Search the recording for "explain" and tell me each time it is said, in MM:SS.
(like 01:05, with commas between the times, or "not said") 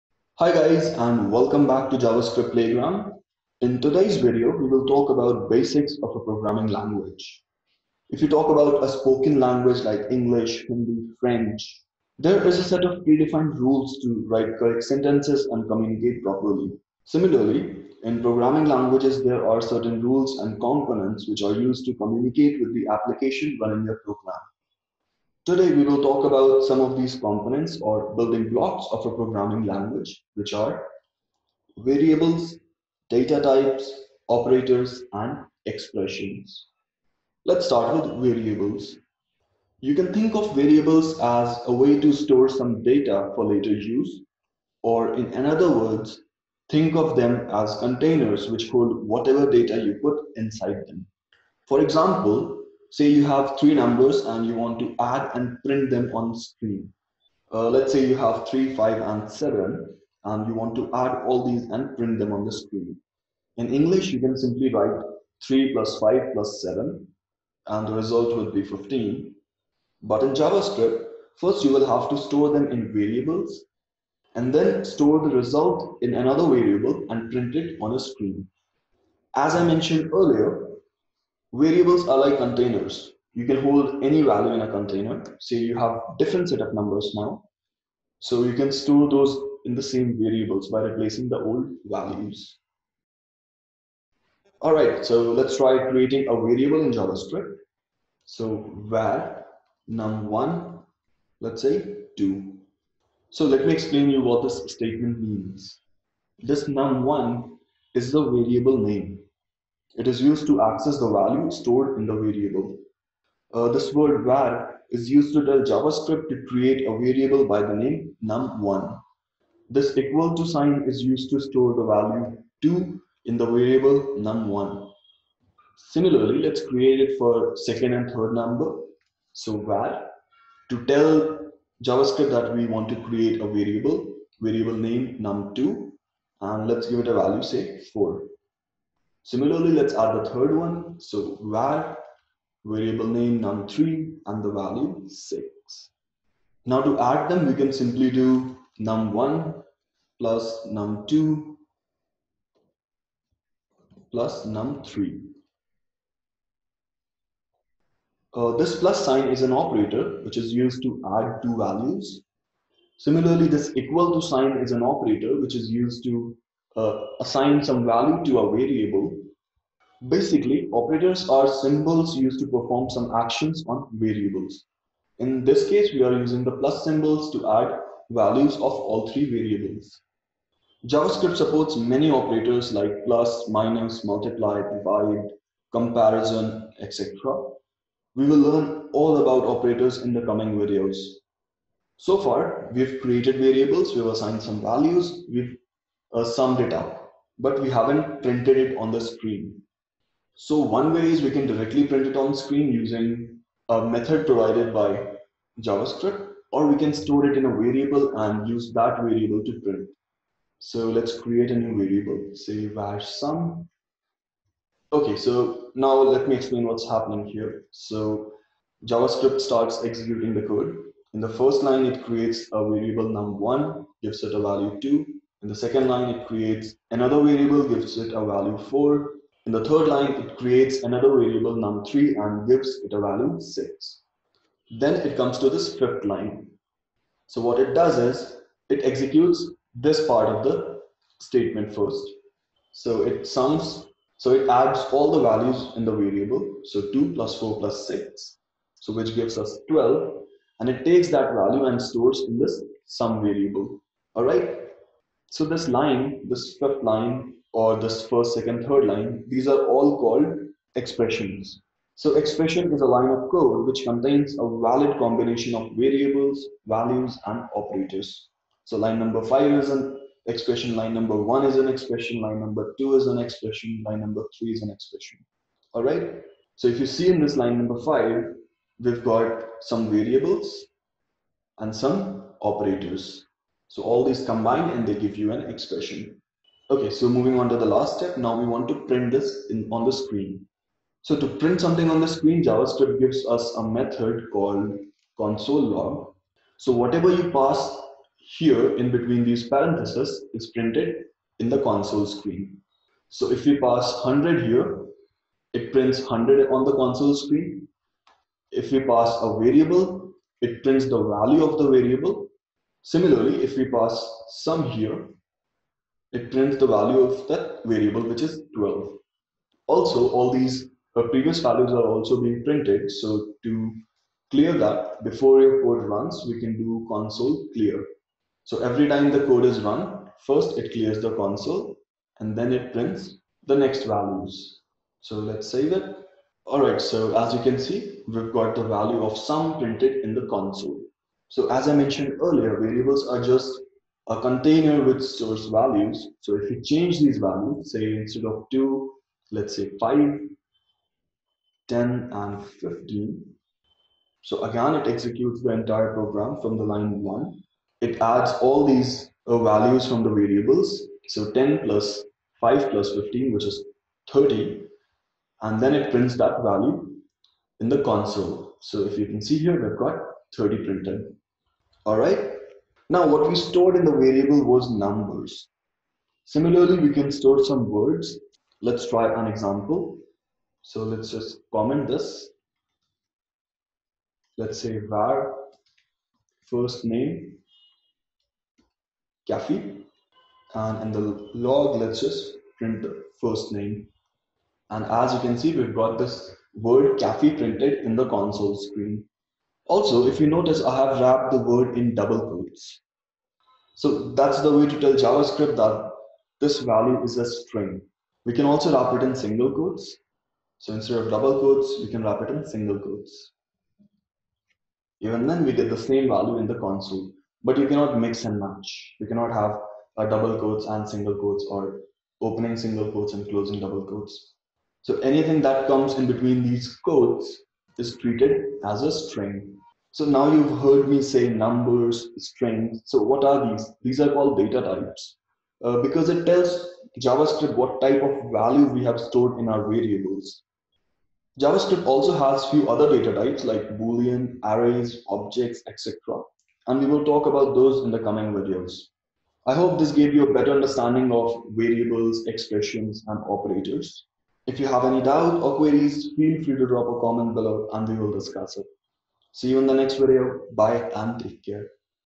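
01:43, 03:36.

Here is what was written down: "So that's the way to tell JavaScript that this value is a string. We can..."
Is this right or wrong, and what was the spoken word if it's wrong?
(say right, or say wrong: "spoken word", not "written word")
right.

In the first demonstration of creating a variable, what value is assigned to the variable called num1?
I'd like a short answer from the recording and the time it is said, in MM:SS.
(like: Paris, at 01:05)
2, at 01:38.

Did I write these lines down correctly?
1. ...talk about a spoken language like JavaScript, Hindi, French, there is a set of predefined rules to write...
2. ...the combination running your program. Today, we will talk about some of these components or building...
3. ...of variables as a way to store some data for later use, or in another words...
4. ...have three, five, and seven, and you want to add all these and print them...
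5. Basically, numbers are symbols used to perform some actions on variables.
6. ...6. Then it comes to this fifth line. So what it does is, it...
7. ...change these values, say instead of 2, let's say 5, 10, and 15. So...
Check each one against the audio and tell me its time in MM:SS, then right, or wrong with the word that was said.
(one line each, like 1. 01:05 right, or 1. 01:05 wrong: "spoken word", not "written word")
1. 00:08 wrong: "English", not "JavaScript"
2. 00:22 wrong: "application", not "combination"
3. 00:40 right
4. 00:58 right
5. 02:50 wrong: "operators", not "numbers"
6. 03:53 right
7. 05:46 right.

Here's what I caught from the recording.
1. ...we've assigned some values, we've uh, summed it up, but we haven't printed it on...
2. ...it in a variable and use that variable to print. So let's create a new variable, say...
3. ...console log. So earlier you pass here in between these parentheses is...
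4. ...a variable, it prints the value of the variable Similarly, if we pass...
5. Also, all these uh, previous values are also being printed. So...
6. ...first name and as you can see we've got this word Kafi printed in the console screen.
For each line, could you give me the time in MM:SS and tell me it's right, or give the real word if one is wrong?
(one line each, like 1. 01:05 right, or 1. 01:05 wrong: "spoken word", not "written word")
1. 03:13 right
2. 03:27 right
3. 04:55 wrong: "whatever", not "earlier"
4. 05:09 right
5. 05:19 right
6. 06:33 right.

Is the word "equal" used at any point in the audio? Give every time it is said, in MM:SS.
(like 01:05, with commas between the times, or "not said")
01:59, 02:43.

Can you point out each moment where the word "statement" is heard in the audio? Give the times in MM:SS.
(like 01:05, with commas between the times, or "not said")
01:44, 04:01.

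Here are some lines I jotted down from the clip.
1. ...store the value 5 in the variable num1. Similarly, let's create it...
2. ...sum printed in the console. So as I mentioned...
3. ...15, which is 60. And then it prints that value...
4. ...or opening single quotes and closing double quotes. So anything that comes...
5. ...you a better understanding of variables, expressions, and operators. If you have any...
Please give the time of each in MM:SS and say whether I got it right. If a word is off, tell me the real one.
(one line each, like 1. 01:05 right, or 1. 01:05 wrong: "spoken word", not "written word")
1. 02:01 wrong: "2", not "5"
2. 05:39 right
3. 06:02 wrong: "30", not "60"
4. 07:01 right
5. 07:30 right.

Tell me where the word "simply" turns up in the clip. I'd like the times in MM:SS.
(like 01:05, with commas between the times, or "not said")
01:04, 02:27.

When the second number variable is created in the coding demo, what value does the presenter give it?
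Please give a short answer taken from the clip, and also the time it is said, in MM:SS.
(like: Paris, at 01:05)
4, at 02:16.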